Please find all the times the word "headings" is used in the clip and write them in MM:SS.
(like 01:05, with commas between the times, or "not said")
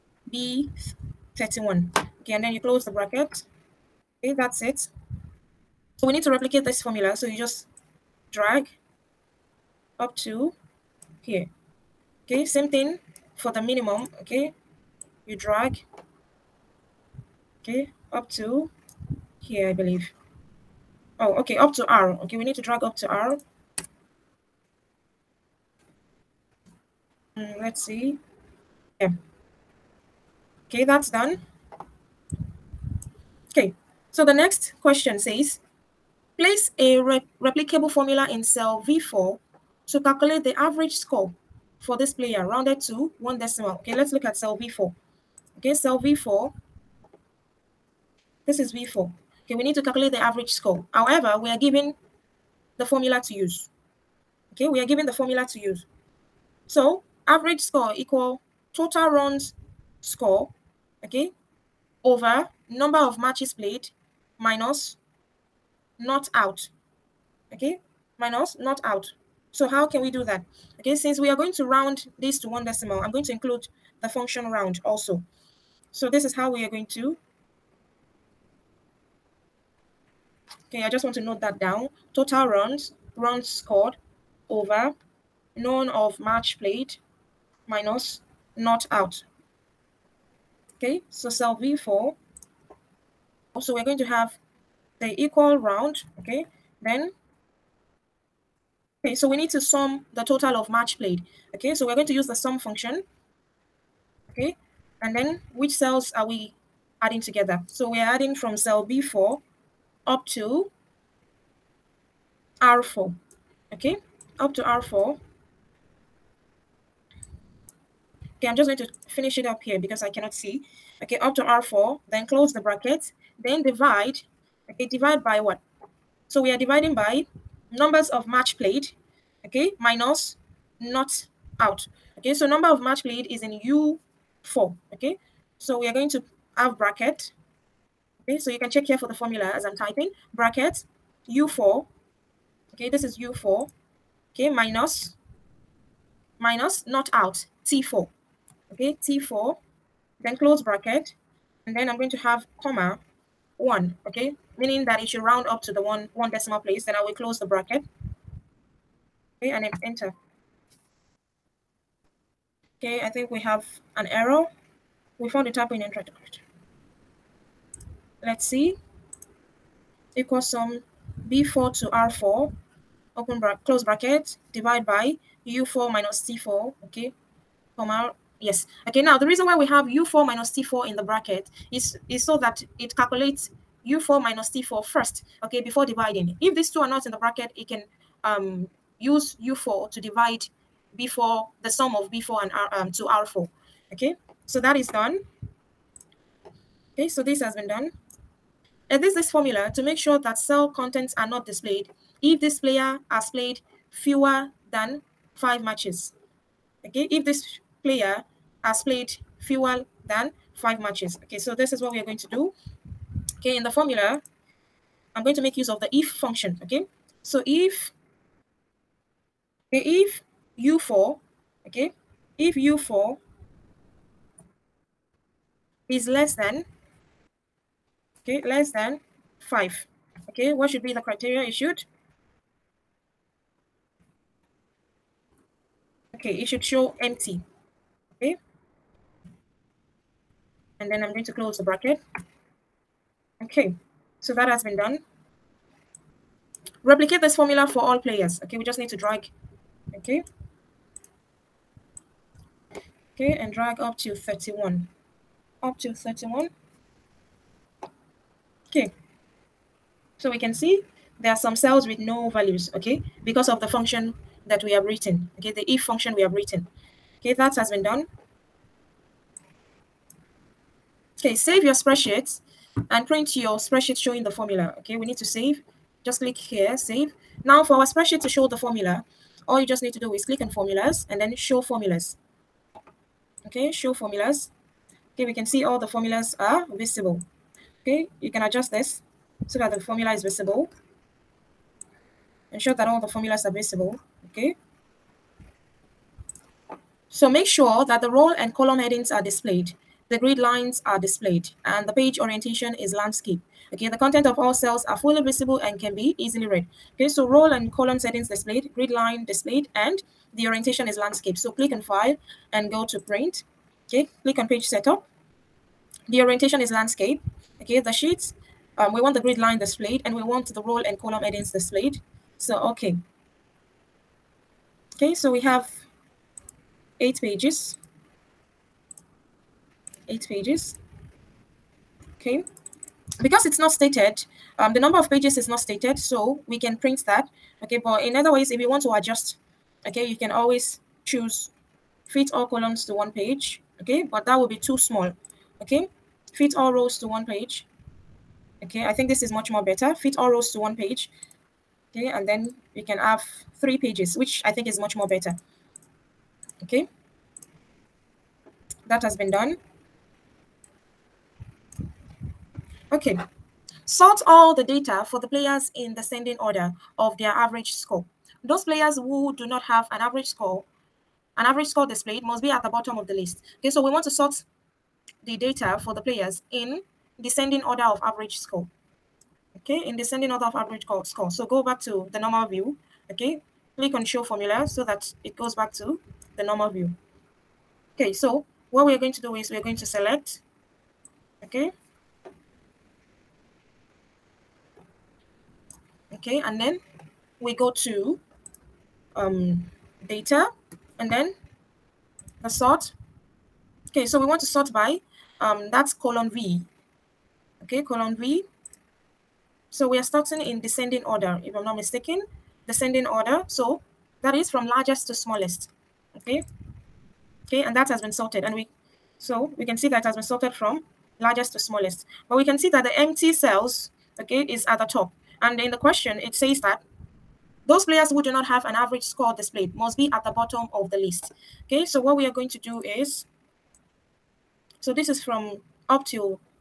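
04:58, 05:21.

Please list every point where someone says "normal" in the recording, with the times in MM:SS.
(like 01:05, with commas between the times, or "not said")
06:22, 06:26.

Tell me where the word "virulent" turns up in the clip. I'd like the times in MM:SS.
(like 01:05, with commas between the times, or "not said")
not said.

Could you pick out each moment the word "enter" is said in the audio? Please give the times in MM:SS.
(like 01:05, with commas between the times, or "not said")
02:39.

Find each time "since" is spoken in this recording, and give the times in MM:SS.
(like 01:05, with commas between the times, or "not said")
01:10.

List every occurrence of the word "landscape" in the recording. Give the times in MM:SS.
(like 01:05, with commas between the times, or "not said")
05:02, 05:10, 05:16.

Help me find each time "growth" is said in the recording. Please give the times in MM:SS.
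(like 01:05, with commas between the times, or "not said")
not said.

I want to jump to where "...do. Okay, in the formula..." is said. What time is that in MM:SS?
03:32.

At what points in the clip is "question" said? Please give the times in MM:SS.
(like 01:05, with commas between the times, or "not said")
00:34, 07:05.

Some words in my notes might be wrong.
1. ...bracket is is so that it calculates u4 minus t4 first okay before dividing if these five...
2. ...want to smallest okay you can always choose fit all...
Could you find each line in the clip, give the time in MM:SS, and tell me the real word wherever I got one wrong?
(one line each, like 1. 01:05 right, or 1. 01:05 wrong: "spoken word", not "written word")
1. 03:01 wrong: "two", not "five"
2. 05:38 wrong: "adjust", not "smallest".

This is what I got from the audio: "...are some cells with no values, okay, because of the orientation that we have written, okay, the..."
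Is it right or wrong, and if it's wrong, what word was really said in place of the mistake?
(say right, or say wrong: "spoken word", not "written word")
wrong: "function", not "orientation".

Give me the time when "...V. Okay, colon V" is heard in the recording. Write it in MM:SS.
06:46.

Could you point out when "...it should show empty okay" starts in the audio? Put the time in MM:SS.
03:56.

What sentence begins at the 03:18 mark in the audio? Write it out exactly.
and this this formula to make sure that cell contents are not displayed if this player has played fewer than five matches.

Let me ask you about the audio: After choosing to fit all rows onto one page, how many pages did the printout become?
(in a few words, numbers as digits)
3.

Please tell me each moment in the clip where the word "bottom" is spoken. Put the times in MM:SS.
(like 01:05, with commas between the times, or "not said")
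06:12, 07:10.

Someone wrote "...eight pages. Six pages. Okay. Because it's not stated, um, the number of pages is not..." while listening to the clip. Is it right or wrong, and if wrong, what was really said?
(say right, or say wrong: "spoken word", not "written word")
wrong: "Eight", not "Six".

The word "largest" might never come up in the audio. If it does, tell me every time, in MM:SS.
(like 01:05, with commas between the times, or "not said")
06:54, 07:01.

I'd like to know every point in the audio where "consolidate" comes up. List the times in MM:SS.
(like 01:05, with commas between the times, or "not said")
not said.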